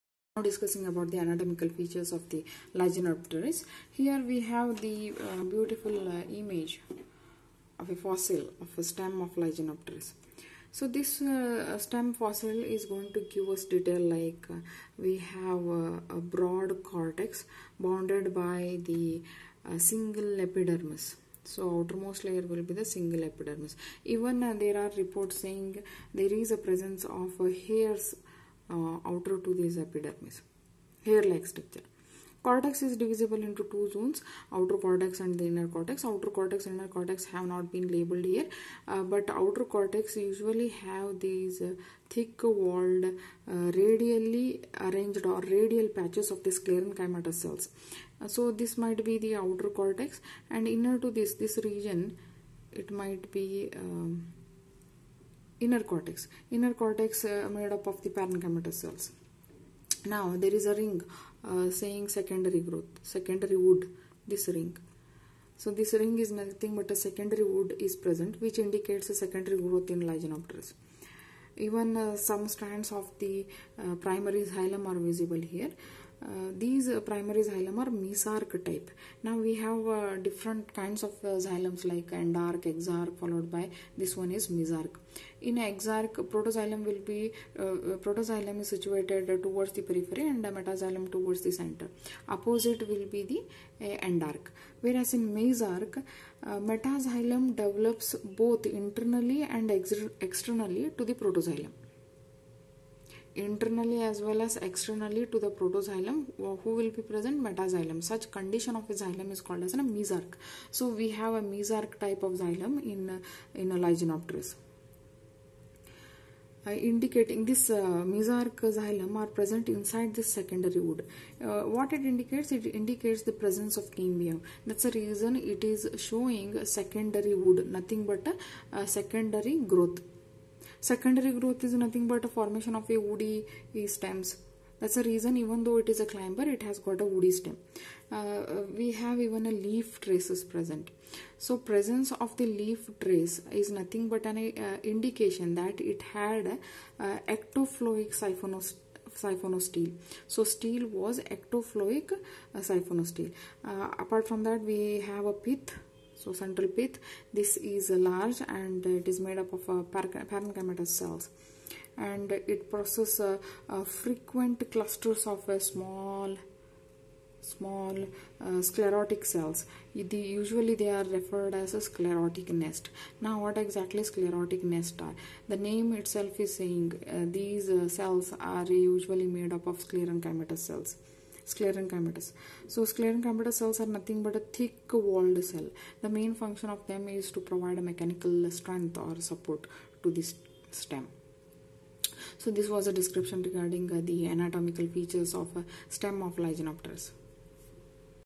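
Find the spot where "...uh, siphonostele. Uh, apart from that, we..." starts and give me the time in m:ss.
2:32.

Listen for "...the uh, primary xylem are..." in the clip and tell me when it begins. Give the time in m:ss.
1:13.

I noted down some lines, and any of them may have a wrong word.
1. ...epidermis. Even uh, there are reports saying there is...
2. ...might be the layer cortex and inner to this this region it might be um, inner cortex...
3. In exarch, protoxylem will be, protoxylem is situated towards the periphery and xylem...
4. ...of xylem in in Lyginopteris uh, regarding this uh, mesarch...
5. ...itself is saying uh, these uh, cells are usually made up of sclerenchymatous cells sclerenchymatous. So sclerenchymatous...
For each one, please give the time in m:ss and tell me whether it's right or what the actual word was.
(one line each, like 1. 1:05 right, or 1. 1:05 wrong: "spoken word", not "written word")
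1. 0:23 right
2. 0:48 wrong: "outer", not "layer"
3. 1:25 wrong: "metaxylem", not "xylem"
4. 1:52 wrong: "indicating", not "regarding"
5. 2:55 right.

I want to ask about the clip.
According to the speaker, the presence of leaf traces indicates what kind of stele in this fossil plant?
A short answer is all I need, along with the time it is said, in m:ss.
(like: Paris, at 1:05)
ectophloic siphonostele, at 2:27.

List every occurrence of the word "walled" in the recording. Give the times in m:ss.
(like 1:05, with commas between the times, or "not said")
0:42, 3:04.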